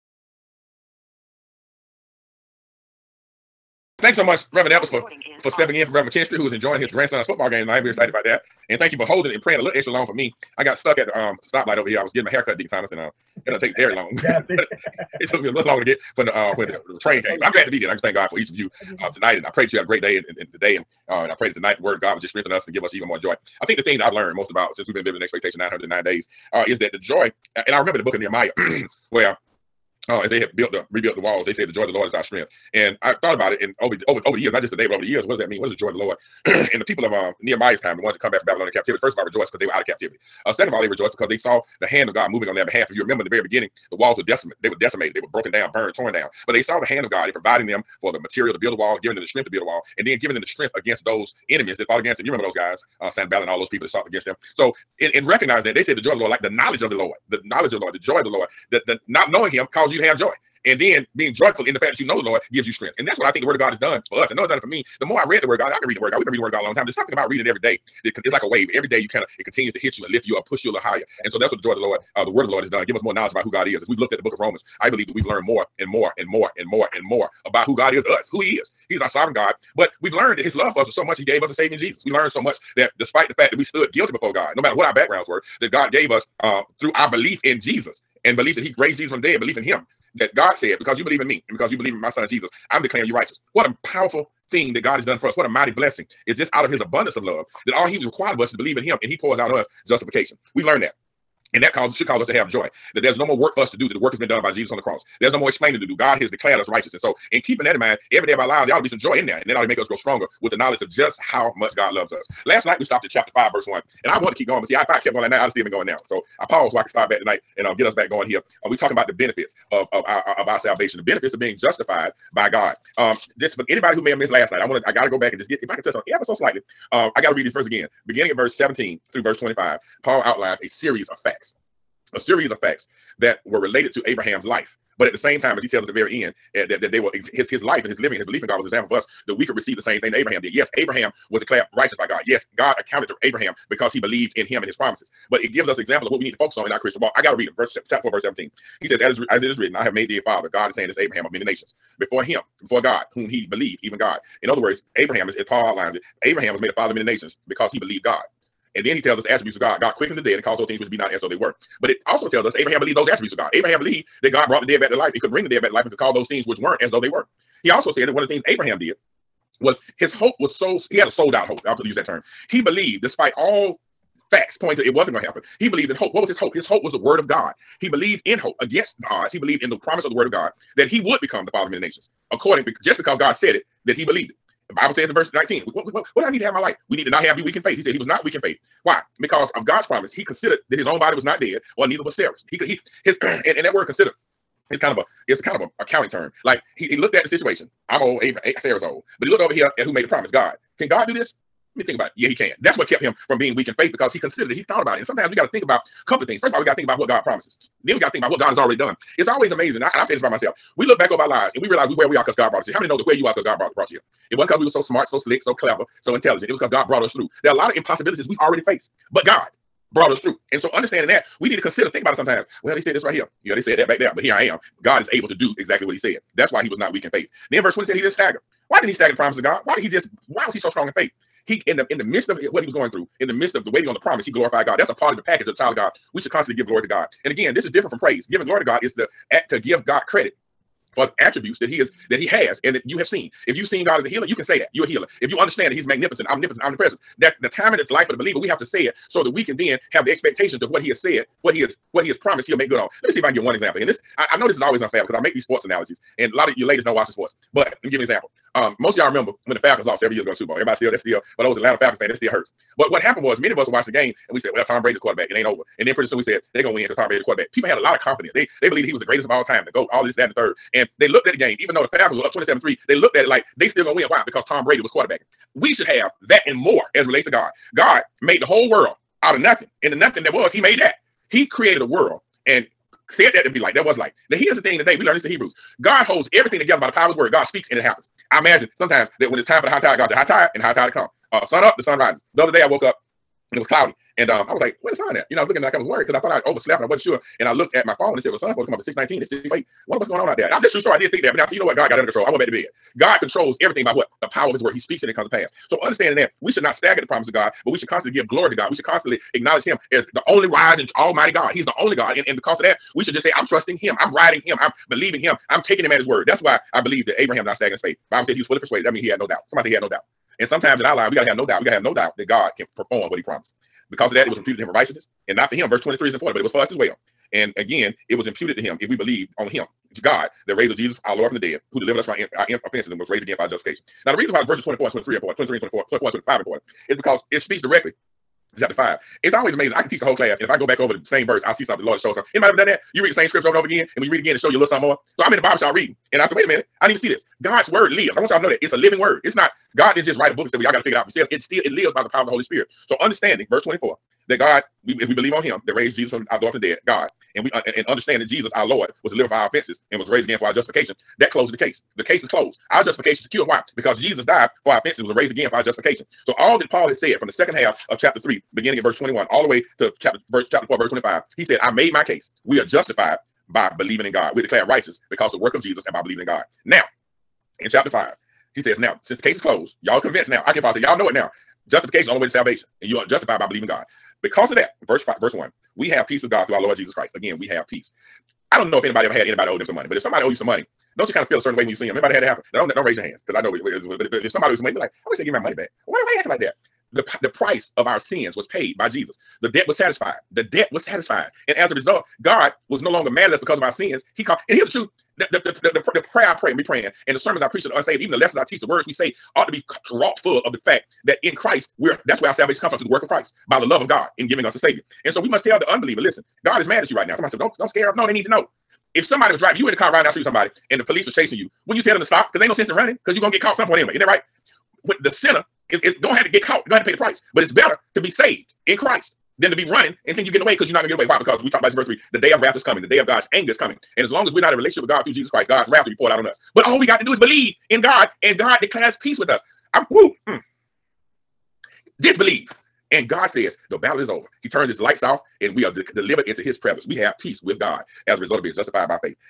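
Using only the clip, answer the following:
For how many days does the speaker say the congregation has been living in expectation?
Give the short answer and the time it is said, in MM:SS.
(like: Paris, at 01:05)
909 days, at 00:25.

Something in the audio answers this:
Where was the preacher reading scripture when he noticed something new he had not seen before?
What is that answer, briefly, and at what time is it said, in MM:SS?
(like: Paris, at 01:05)
the barbershop, at 05:45.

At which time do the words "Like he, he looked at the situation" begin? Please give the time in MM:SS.
03:16.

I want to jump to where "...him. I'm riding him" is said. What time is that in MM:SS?
05:13.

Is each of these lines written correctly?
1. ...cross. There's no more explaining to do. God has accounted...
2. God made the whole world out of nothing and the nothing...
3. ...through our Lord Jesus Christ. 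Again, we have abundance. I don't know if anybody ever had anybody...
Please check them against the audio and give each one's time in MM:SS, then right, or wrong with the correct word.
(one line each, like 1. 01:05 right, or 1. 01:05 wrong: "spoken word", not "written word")
1. 01:44 wrong: "declared", not "accounted"
2. 04:37 right
3. 06:26 wrong: "peace", not "abundance".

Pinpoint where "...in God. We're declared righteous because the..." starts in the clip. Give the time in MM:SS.
06:14.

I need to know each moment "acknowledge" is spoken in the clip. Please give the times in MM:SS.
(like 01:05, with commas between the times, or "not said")
05:09.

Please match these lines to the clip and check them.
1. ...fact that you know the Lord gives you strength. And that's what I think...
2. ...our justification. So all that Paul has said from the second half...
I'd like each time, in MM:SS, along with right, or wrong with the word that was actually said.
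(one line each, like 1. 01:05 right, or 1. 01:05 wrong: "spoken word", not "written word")
1. 01:01 right
2. 06:05 right.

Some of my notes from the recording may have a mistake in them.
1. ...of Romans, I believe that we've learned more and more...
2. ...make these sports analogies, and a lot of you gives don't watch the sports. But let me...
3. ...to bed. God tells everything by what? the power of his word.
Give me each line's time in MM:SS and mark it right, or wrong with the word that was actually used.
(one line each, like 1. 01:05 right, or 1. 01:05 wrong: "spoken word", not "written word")
1. 01:14 right
2. 04:15 wrong: "ladies", not "gives"
3. 05:02 wrong: "controls", not "tells".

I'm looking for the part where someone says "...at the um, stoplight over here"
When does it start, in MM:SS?
00:10.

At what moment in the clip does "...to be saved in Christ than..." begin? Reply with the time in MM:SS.
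07:07.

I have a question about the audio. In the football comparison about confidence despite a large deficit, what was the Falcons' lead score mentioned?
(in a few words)
27-3.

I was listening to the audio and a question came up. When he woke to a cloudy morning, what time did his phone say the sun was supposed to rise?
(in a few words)
6:19.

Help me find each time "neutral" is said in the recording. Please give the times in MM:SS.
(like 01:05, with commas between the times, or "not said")
not said.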